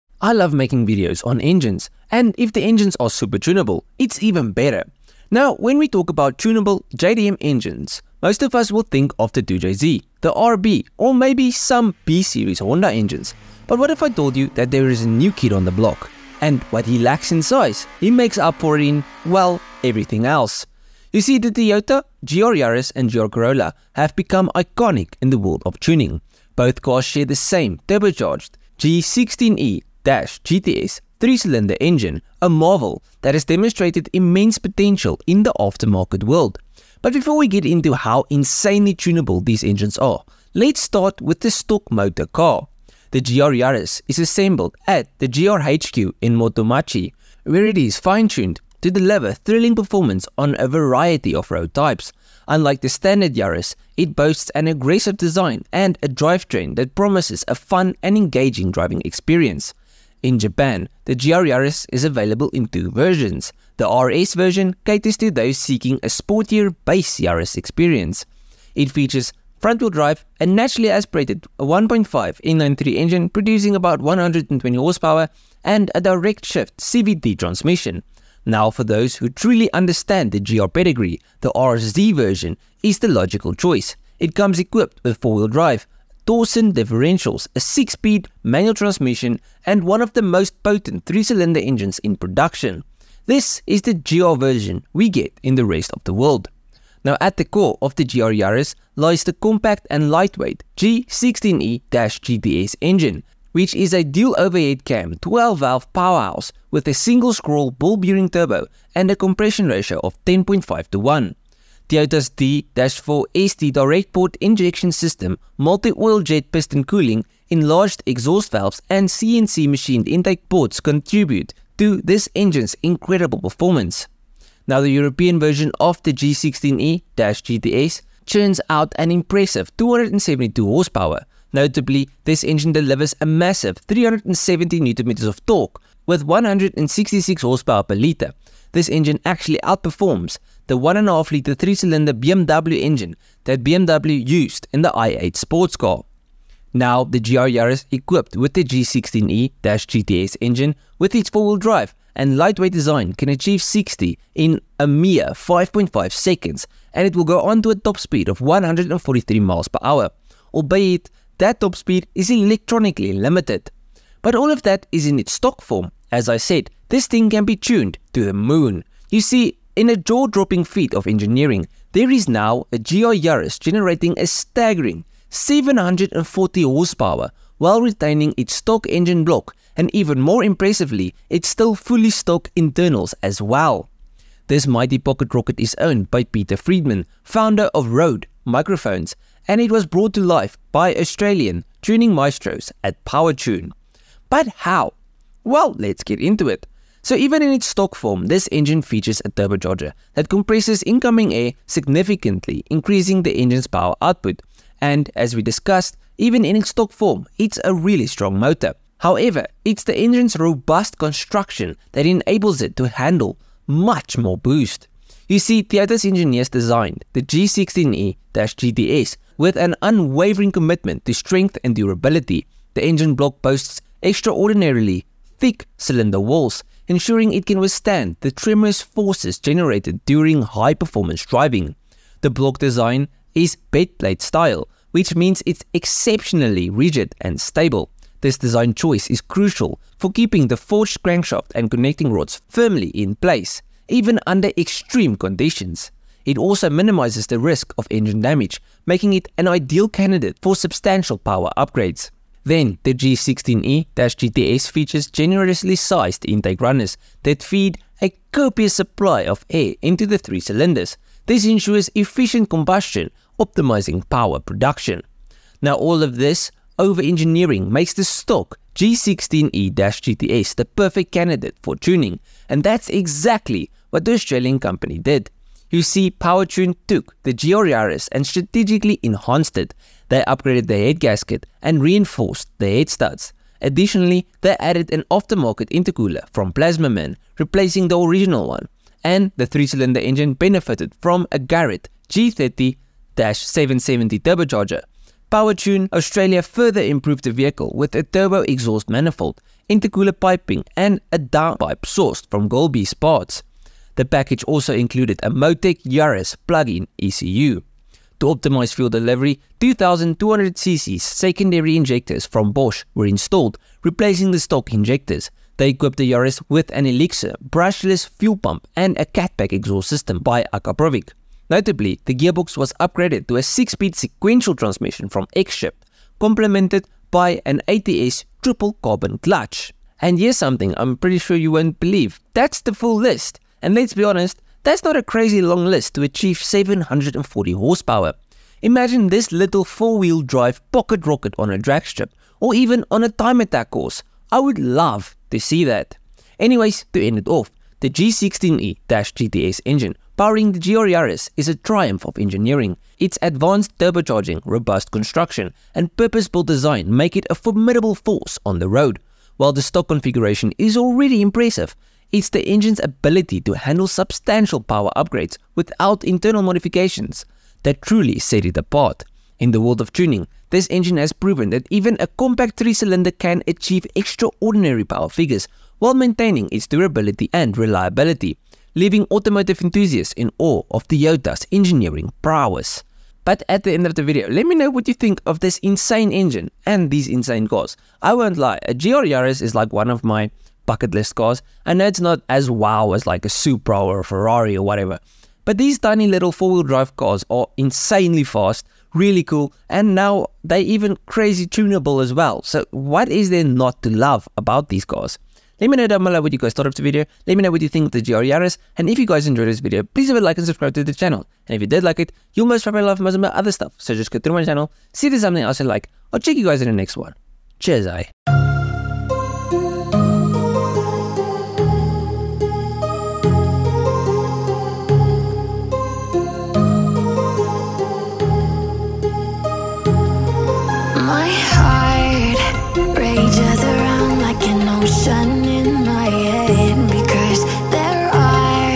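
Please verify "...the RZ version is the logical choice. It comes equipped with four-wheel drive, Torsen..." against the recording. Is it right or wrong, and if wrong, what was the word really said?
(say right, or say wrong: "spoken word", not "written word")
right.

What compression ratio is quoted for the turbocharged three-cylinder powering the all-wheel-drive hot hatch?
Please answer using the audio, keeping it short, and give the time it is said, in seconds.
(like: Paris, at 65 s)
10.5 to 1, at 110 s.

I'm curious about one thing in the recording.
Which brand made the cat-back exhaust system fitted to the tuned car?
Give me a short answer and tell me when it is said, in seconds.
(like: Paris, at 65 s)
Akrapovic, at 320 s.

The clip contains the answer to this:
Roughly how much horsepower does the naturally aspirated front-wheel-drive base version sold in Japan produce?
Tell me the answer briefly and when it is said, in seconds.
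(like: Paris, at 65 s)
120, at 74 s.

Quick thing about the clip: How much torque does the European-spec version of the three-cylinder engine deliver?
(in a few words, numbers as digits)
370 Nm.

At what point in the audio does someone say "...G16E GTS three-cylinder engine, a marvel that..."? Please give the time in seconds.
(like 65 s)
28 s.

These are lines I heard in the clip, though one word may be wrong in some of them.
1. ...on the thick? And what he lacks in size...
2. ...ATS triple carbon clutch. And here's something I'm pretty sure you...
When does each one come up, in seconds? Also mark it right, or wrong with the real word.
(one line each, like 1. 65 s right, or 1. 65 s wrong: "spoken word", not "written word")
1. 15 s wrong: "block", not "thick"
2. 327 s right.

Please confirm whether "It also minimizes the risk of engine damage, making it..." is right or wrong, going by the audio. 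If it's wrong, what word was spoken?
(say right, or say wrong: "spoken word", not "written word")
right.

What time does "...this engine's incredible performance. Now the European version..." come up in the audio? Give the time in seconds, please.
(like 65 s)
122 s.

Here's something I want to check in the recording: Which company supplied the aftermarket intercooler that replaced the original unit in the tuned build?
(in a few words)
Plazmaman.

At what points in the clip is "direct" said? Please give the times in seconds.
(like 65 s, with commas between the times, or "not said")
76 s, 113 s.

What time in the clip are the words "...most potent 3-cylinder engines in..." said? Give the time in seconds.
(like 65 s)
90 s.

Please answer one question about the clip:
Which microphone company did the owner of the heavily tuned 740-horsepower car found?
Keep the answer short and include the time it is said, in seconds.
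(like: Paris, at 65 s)
Rode Microphones, at 187 s.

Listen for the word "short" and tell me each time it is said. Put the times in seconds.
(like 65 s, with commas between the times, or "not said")
not said.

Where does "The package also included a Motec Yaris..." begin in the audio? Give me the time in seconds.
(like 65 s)
303 s.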